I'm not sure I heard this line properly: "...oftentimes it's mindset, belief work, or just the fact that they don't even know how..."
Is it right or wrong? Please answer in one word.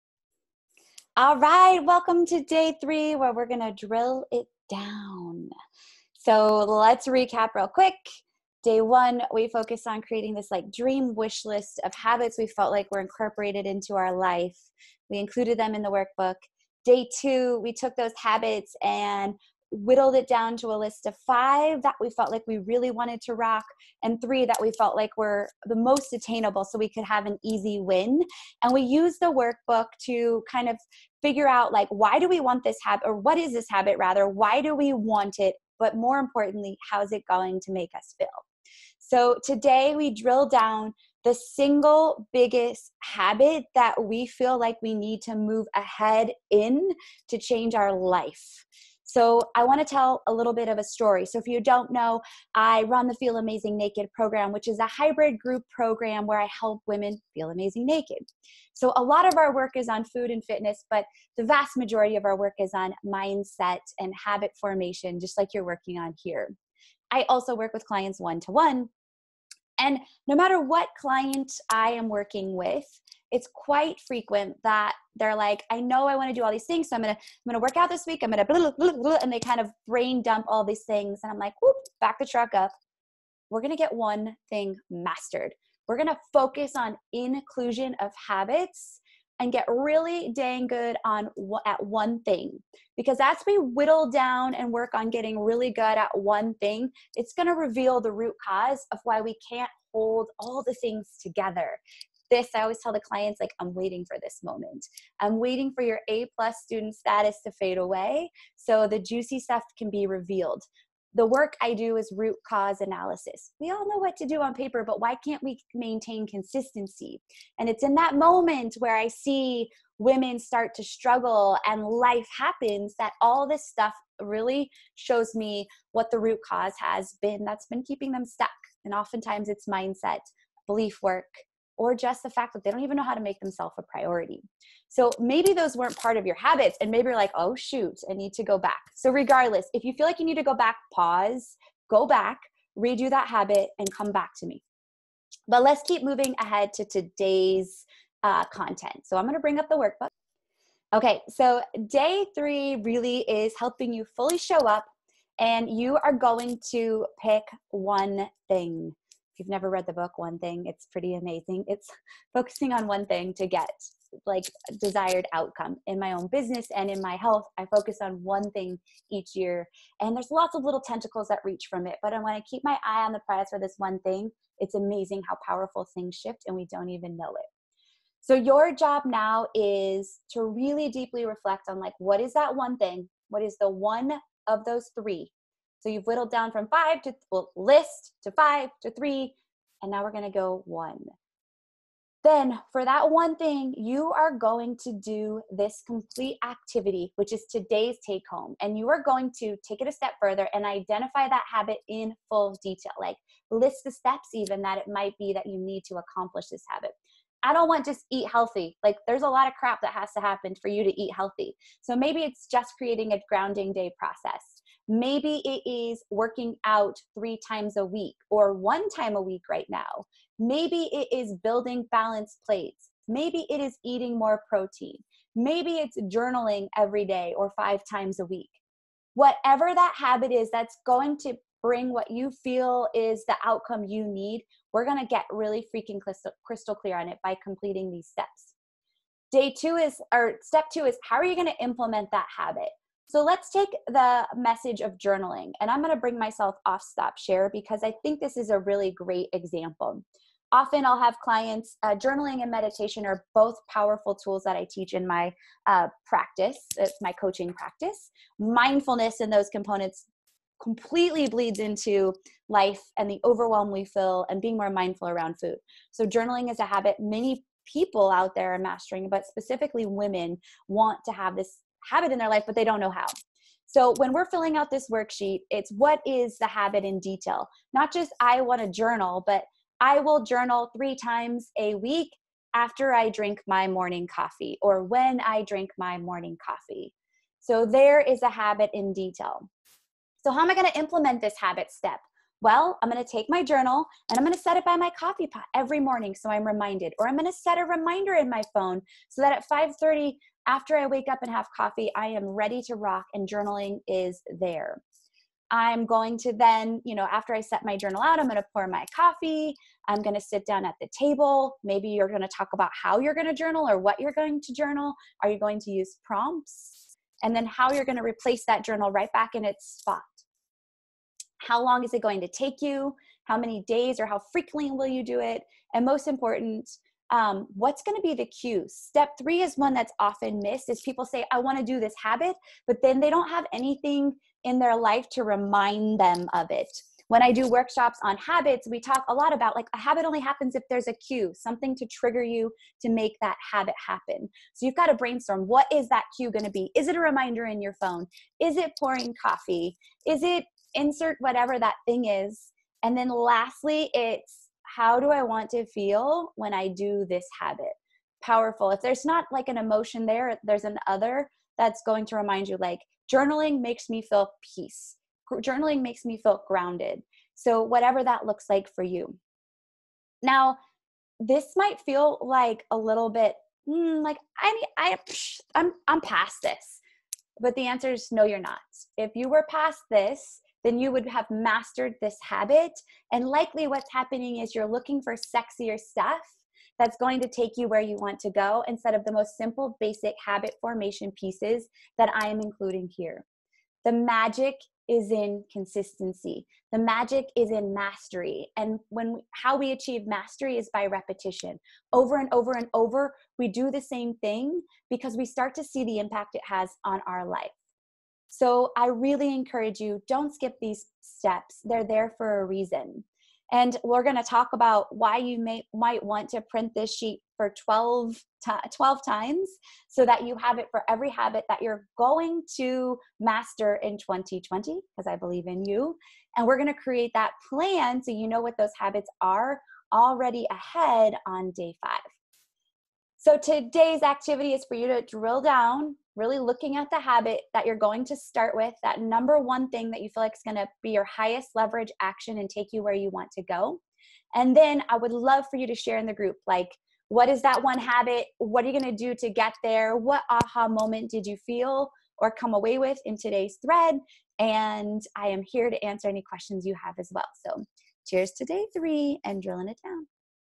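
right.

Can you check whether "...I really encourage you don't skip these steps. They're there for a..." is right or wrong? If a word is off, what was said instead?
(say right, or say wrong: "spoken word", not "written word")
right.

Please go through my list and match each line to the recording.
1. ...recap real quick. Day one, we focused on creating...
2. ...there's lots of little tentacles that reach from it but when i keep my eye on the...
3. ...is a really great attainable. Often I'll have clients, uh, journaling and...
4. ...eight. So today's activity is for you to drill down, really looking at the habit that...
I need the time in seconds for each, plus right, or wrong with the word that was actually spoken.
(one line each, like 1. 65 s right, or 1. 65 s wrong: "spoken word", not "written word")
1. 7 s right
2. 170 s right
3. 248 s wrong: "example", not "attainable"
4. 431 s wrong: "five", not "eight".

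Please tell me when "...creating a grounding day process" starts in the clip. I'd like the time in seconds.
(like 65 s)
212 s.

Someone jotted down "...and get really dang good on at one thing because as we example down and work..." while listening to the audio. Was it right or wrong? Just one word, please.
wrong.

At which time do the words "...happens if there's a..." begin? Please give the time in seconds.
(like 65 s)
340 s.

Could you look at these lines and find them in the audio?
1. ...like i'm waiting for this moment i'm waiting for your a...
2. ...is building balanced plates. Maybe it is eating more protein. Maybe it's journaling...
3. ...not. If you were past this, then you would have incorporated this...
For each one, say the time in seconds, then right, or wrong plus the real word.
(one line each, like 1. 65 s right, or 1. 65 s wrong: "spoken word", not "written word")
1. 103 s right
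2. 221 s right
3. 378 s wrong: "mastered", not "incorporated".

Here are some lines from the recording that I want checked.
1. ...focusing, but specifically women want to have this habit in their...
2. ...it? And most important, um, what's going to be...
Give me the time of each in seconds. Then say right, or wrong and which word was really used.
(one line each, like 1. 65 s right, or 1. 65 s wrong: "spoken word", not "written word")
1. 268 s wrong: "mastering", not "focusing"
2. 325 s right.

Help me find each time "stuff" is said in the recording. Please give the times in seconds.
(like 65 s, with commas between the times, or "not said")
109 s, 123 s, 385 s.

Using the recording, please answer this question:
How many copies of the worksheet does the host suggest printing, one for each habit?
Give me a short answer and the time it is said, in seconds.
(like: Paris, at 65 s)
12, at 418 s.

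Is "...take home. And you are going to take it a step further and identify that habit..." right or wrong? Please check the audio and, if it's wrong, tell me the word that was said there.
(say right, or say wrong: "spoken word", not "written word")
right.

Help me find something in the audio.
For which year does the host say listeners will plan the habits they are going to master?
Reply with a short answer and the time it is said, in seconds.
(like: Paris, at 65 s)
2020, at 423 s.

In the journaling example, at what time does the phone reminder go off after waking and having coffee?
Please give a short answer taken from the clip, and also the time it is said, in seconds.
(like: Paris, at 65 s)
5:30, at 299 s.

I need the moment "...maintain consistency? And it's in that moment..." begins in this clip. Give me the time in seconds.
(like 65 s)
115 s.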